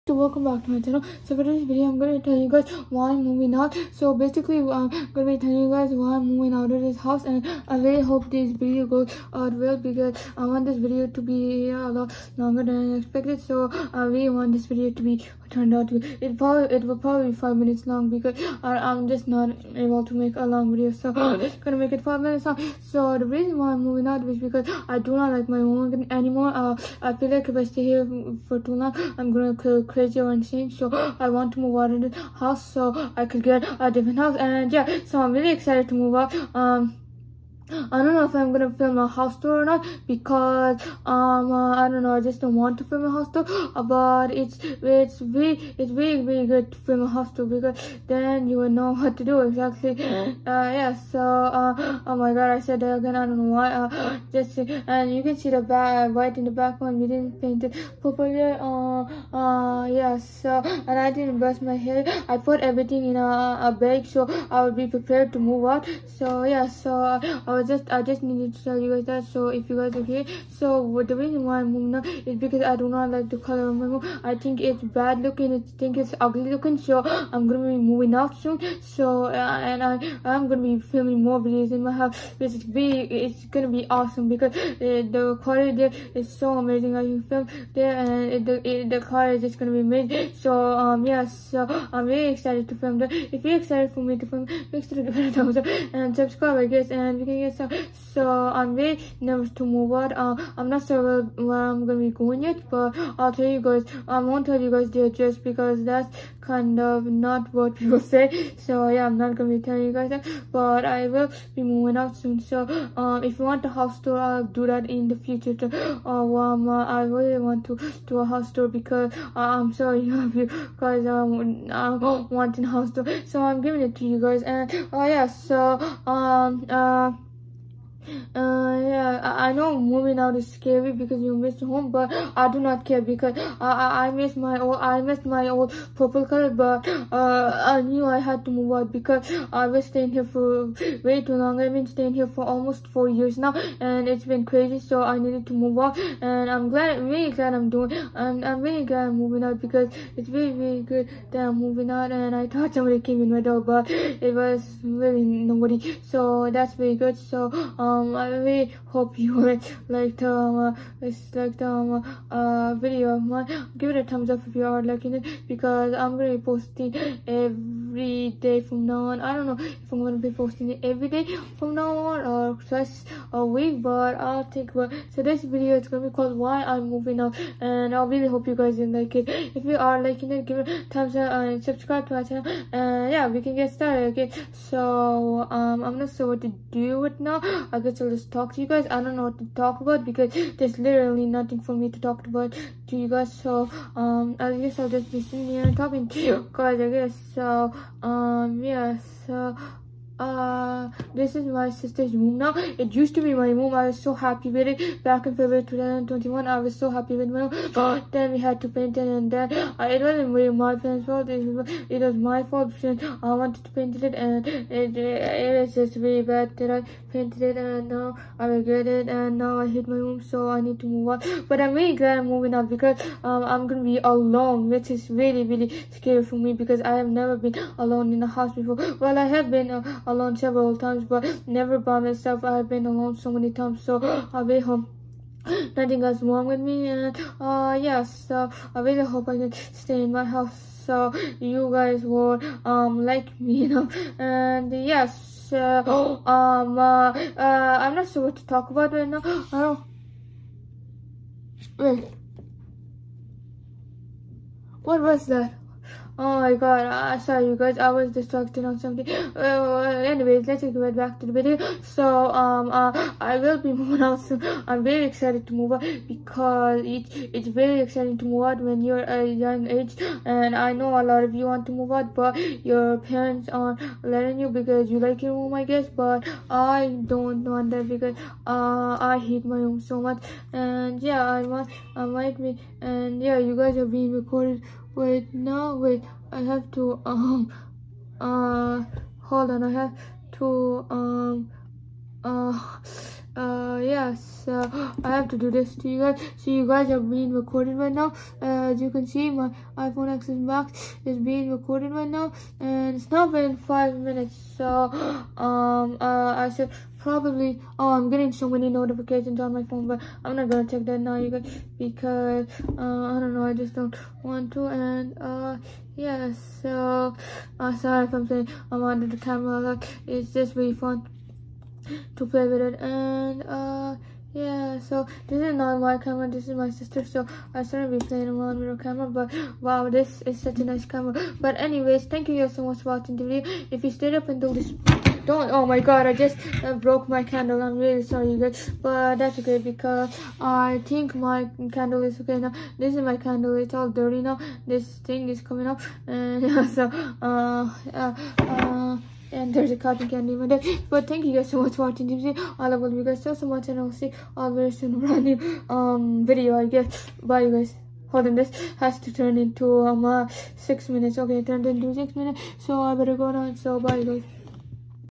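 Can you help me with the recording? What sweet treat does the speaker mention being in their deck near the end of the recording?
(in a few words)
Cotton candy.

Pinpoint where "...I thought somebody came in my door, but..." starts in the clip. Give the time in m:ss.
2:32.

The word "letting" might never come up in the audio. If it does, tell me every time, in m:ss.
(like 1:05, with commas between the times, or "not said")
4:34.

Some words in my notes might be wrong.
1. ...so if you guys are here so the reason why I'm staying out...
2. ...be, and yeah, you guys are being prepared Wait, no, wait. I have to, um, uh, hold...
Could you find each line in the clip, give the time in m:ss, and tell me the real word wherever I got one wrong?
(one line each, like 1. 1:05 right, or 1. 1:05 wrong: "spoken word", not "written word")
1. 1:09 wrong: "moving", not "staying"
2. 4:42 wrong: "recorded", not "prepared".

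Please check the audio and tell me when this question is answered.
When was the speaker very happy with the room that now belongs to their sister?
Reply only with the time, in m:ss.
3:25.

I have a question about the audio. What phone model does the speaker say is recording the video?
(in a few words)
iPhone XS Max.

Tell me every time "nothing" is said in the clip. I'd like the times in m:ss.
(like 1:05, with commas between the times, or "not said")
3:11, 3:55.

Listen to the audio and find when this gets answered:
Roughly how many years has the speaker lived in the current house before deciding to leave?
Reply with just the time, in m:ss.
2:22.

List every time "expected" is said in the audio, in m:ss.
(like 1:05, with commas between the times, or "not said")
0:12.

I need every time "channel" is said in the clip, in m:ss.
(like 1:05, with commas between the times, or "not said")
0:00, 3:02.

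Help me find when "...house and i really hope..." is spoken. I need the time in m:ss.
0:06.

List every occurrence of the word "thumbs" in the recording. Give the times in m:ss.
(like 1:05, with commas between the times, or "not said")
1:35, 2:44, 3:00.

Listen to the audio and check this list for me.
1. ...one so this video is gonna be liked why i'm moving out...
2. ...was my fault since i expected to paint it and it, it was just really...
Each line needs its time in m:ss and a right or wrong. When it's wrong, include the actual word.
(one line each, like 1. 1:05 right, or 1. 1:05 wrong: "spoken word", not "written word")
1. 2:54 wrong: "called", not "liked"
2. 3:32 wrong: "wanted", not "expected".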